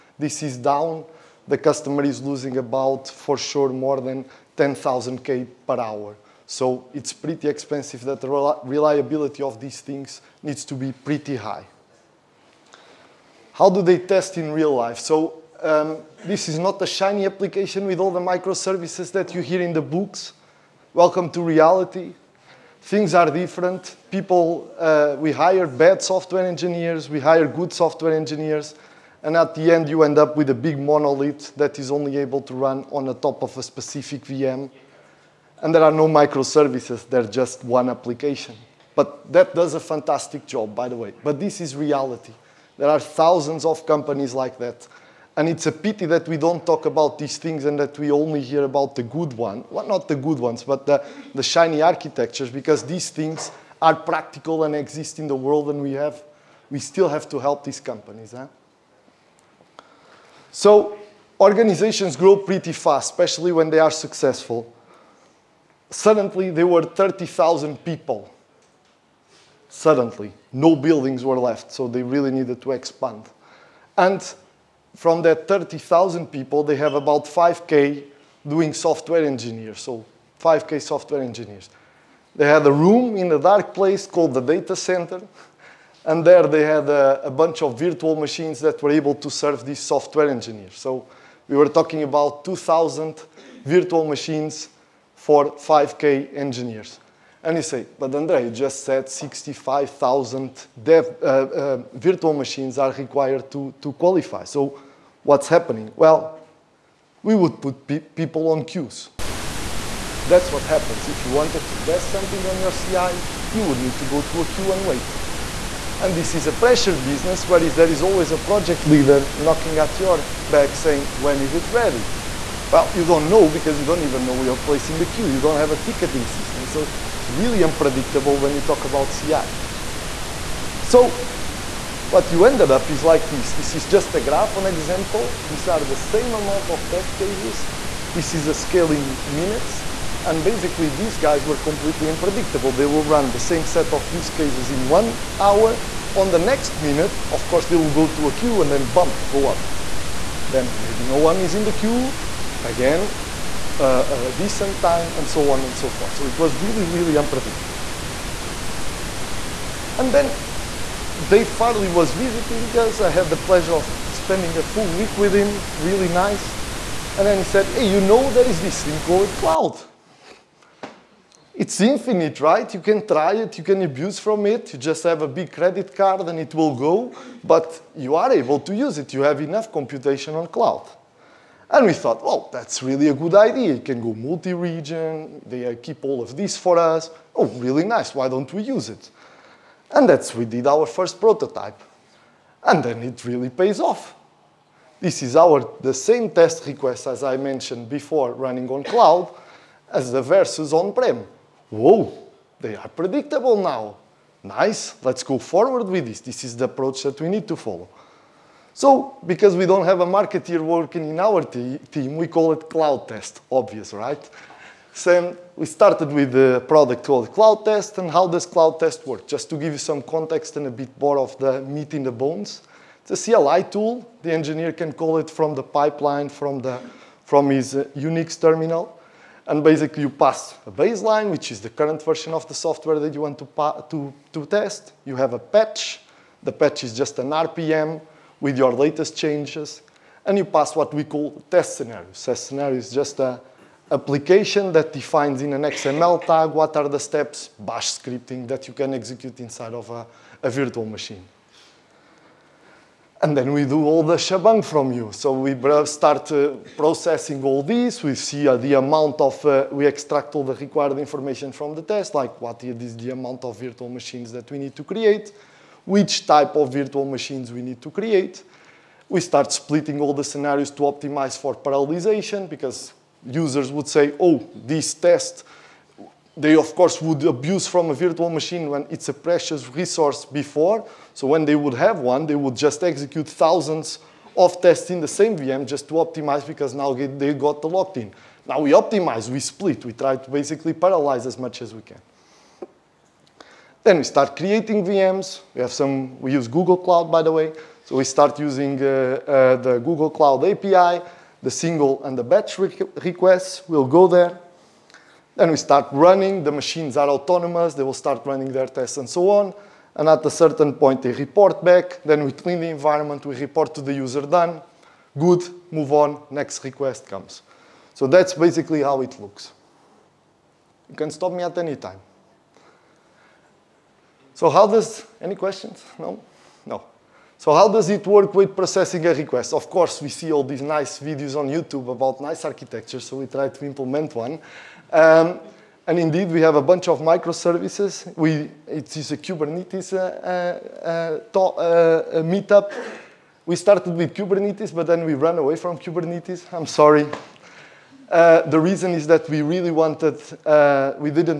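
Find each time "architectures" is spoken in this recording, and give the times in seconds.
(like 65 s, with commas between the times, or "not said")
51 s, 332 s.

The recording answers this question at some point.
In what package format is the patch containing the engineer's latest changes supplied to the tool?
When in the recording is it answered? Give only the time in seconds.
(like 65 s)
237 s.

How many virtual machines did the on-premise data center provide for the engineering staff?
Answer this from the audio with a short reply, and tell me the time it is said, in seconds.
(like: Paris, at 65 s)
2,000, at 92 s.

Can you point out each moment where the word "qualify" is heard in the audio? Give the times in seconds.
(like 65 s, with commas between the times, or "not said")
103 s.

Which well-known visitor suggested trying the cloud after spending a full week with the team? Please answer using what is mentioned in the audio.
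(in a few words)
Dave Farley.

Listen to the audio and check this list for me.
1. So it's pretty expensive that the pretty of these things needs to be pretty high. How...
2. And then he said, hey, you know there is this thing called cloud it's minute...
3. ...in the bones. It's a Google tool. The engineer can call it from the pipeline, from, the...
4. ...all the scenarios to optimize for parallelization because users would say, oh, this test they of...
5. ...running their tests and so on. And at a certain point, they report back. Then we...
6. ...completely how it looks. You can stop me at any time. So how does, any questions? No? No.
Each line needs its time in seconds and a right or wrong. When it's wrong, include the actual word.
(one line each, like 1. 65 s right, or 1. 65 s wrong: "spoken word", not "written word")
1. 6 s wrong: "reliability", not "pretty"
2. 167 s wrong: "infinite", not "minute"
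3. 221 s wrong: "CLI", not "Google"
4. 270 s right
5. 308 s right
6. 318 s wrong: "basically", not "completely".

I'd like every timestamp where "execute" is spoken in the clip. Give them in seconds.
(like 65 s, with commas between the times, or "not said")
248 s, 282 s.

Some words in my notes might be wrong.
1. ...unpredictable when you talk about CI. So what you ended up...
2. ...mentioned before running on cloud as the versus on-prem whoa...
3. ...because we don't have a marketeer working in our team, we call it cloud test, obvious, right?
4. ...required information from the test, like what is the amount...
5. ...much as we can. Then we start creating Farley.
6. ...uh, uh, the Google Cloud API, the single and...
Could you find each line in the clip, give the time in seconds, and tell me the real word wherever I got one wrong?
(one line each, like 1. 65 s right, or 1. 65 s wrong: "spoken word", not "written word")
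1. 127 s right
2. 197 s right
3. 209 s right
4. 260 s right
5. 291 s wrong: "VMs", not "Farley"
6. 298 s right.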